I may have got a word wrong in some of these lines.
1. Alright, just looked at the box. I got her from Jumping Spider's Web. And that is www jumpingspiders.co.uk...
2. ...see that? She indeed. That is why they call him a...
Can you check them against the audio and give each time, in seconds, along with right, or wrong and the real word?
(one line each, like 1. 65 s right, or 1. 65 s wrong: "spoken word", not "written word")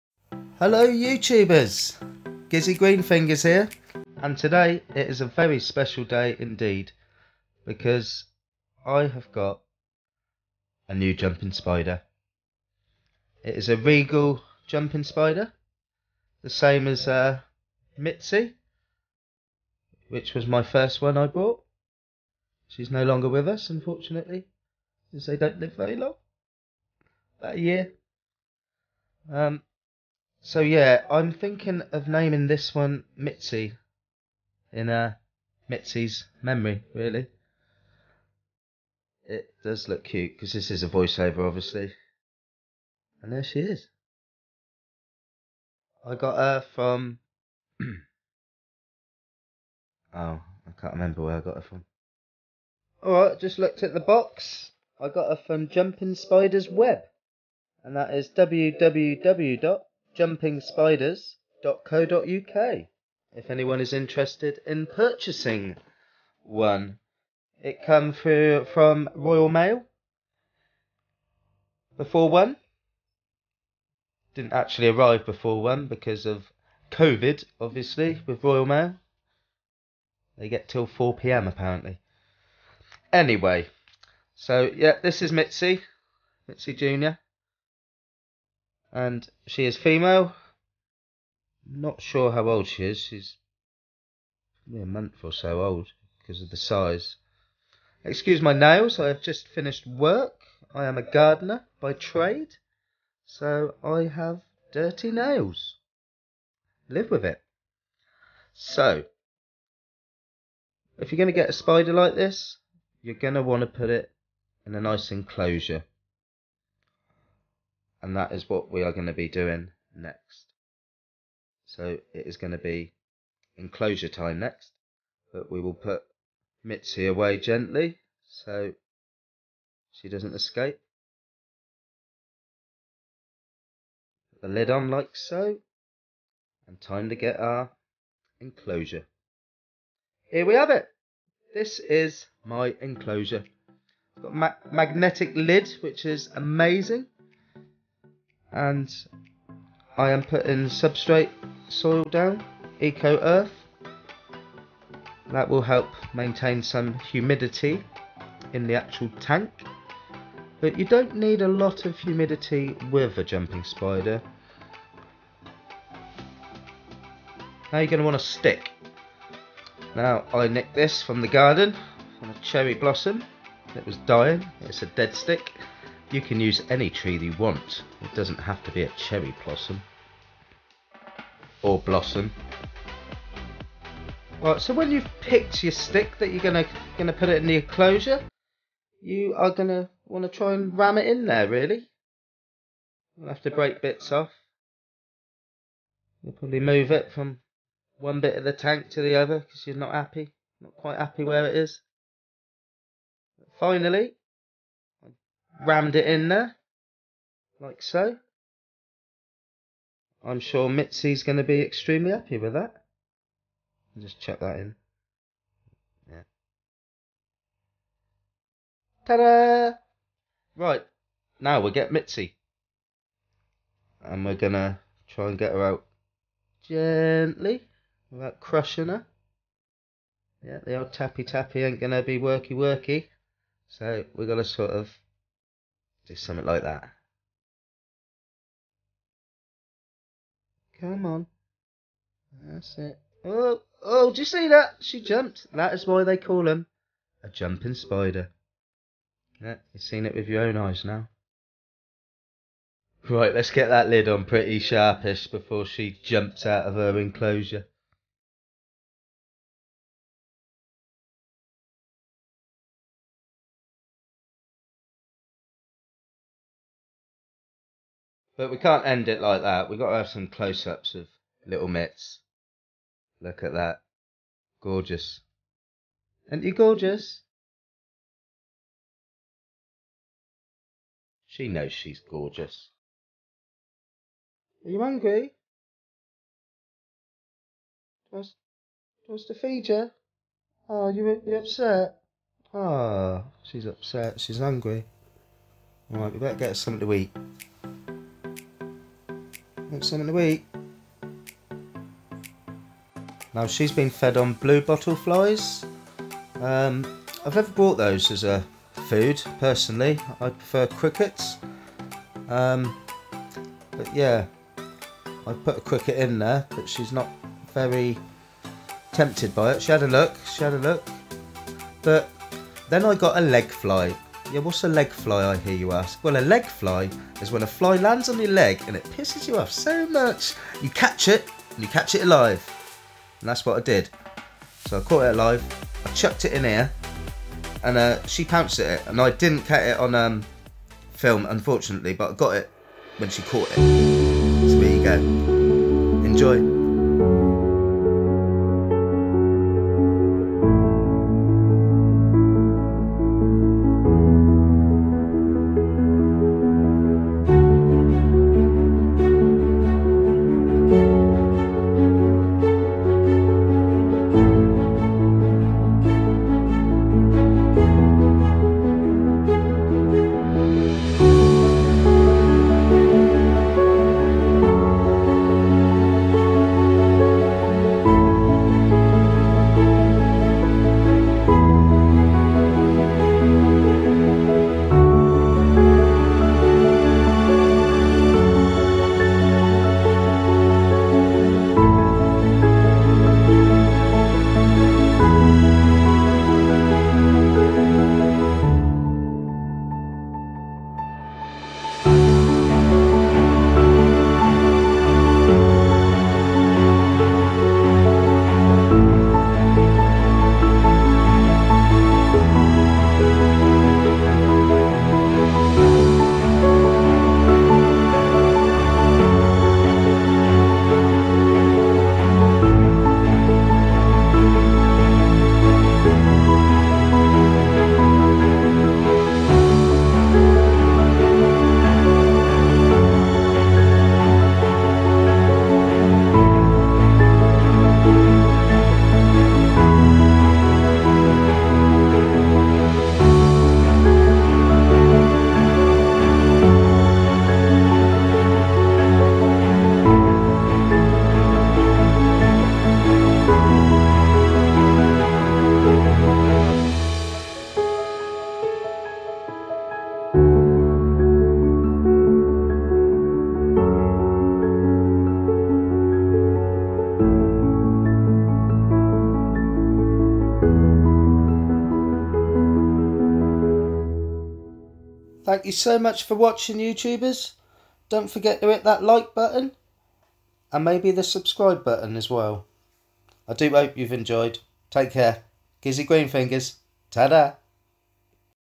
1. 53 s right
2. 244 s wrong: "jumped", not "indeed".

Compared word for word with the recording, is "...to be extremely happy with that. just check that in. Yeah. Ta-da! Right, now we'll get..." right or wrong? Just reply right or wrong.
right.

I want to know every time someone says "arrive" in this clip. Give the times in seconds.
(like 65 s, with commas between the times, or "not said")
74 s.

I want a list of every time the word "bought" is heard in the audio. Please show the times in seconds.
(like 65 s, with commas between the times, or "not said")
21 s, 307 s.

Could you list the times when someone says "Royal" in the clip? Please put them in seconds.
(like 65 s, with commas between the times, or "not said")
69 s, 78 s.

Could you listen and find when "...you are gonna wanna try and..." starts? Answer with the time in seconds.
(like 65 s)
189 s.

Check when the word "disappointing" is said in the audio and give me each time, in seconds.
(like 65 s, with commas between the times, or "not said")
not said.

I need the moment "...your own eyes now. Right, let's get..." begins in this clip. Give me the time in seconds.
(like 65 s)
250 s.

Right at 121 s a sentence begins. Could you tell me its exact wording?
So it is going to be enclosure time next, but we will put Mitzy away gently so she doesn't escape.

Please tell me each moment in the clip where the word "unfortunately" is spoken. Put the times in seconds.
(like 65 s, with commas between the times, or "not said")
23 s, 341 s.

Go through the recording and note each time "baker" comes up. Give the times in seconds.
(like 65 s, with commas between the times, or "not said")
not said.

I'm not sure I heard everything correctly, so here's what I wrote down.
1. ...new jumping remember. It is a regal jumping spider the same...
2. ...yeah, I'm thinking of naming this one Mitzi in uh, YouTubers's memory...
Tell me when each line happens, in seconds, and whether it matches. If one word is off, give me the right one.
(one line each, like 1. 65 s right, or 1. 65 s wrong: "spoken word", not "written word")
1. 10 s wrong: "spider", not "remember"
2. 30 s wrong: "Mitzi", not "YouTubers".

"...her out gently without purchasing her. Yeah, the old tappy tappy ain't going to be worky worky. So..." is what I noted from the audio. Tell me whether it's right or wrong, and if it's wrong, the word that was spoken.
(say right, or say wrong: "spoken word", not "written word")
wrong: "crushing", not "purchasing".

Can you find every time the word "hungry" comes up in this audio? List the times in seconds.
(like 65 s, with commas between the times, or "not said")
284 s, 294 s.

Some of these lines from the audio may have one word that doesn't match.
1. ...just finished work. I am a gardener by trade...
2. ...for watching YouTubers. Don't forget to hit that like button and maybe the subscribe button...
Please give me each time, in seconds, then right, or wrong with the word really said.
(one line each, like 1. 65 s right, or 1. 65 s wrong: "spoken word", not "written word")
1. 99 s right
2. 476 s right.